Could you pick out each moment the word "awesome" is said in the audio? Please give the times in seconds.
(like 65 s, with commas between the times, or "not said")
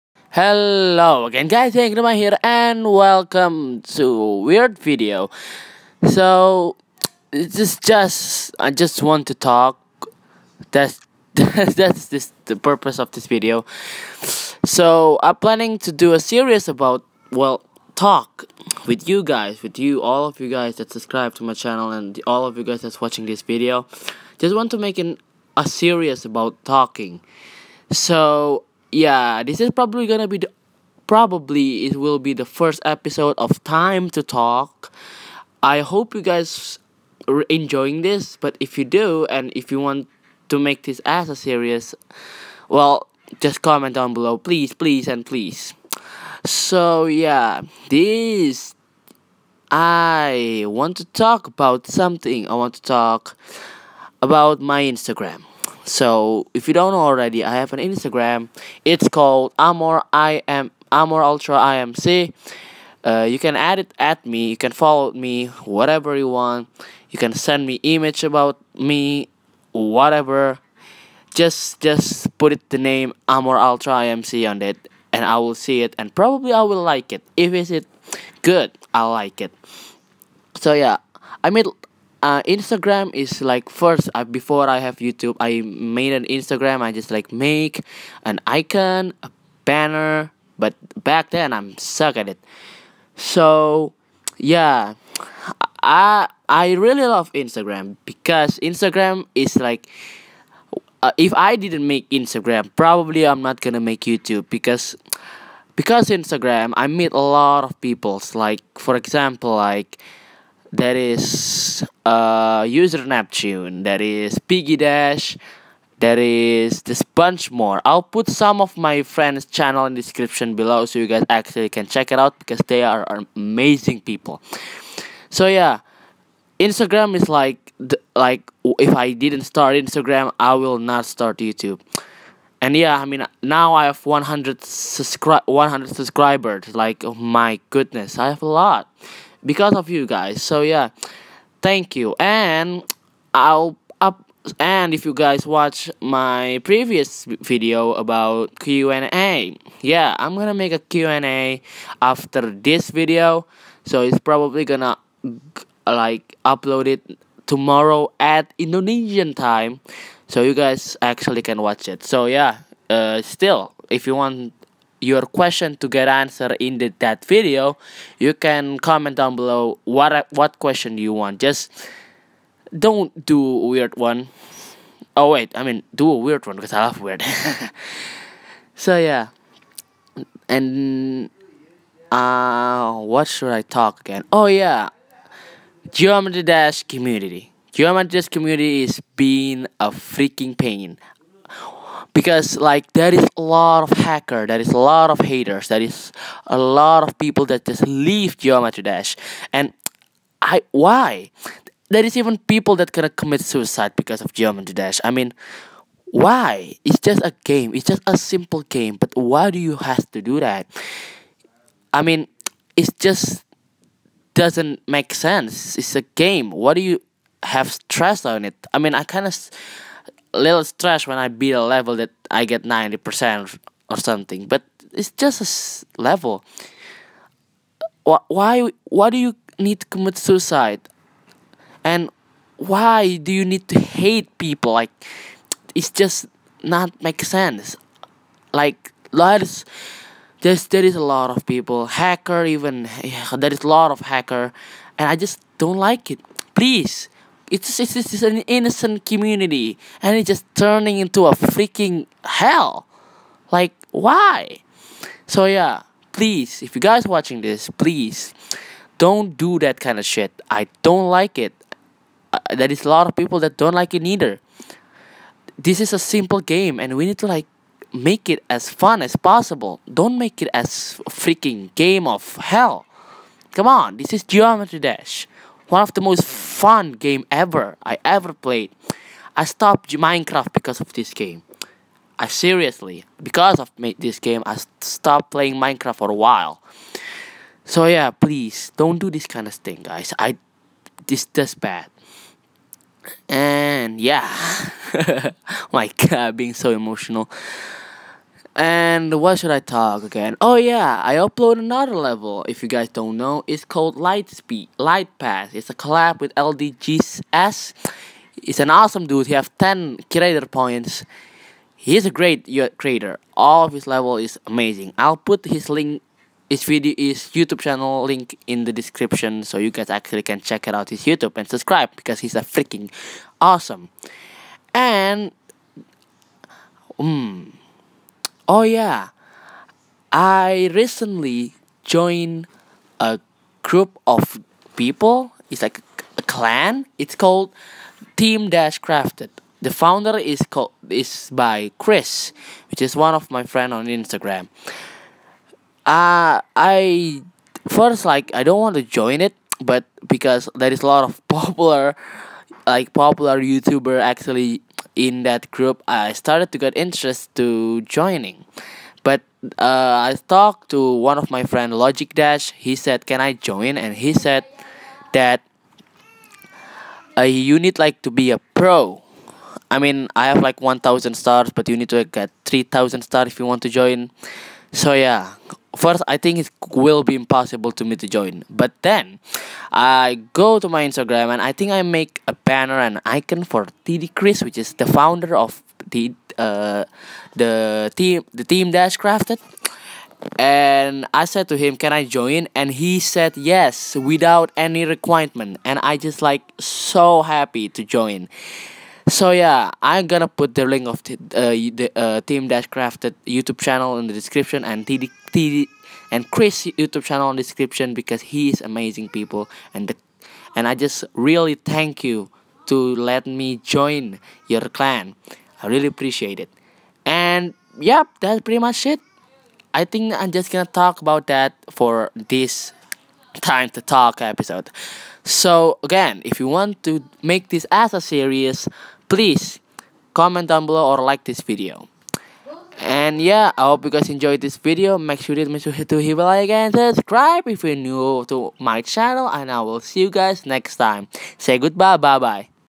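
308 s, 323 s.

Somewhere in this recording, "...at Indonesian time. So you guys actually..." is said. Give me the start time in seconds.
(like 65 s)
158 s.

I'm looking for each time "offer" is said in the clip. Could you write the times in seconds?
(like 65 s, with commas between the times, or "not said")
not said.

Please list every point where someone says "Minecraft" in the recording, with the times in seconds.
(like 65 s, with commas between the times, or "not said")
279 s, 285 s.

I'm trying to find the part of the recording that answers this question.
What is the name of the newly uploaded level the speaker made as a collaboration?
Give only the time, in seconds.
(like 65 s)
303 s.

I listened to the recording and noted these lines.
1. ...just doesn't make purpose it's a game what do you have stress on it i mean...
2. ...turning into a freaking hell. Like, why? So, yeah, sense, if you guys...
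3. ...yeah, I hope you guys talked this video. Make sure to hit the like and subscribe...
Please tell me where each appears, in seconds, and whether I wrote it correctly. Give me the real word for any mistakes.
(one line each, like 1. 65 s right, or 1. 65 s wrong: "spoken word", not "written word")
1. 212 s wrong: "sense", not "purpose"
2. 250 s wrong: "please", not "sense"
3. 433 s wrong: "enjoyed", not "talked".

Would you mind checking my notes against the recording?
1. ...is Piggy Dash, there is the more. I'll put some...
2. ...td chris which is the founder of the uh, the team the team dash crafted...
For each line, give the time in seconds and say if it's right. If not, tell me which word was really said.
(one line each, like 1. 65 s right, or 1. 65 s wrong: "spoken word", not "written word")
1. 114 s right
2. 383 s right.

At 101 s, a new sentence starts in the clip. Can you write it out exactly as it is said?
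Uh, if I didn't make Instagram, probably I'm not gonna make YouTube because because Instagram I meet a lot of people.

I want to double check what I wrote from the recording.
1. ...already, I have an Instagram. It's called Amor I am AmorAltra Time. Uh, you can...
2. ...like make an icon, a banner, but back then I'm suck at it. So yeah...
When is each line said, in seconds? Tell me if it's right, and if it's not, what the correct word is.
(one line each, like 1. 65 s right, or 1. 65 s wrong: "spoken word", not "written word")
1. 56 s wrong: "IMC", not "Time"
2. 87 s right.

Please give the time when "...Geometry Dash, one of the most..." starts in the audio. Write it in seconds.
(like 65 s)
274 s.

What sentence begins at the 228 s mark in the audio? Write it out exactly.
Why, why do you need to commit suicide?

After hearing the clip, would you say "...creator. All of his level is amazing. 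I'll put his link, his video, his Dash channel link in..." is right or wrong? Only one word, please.
wrong.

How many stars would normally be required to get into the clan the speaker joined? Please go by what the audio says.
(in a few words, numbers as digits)
3,000.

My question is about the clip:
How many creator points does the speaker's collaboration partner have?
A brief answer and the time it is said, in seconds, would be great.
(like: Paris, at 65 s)
10, at 309 s.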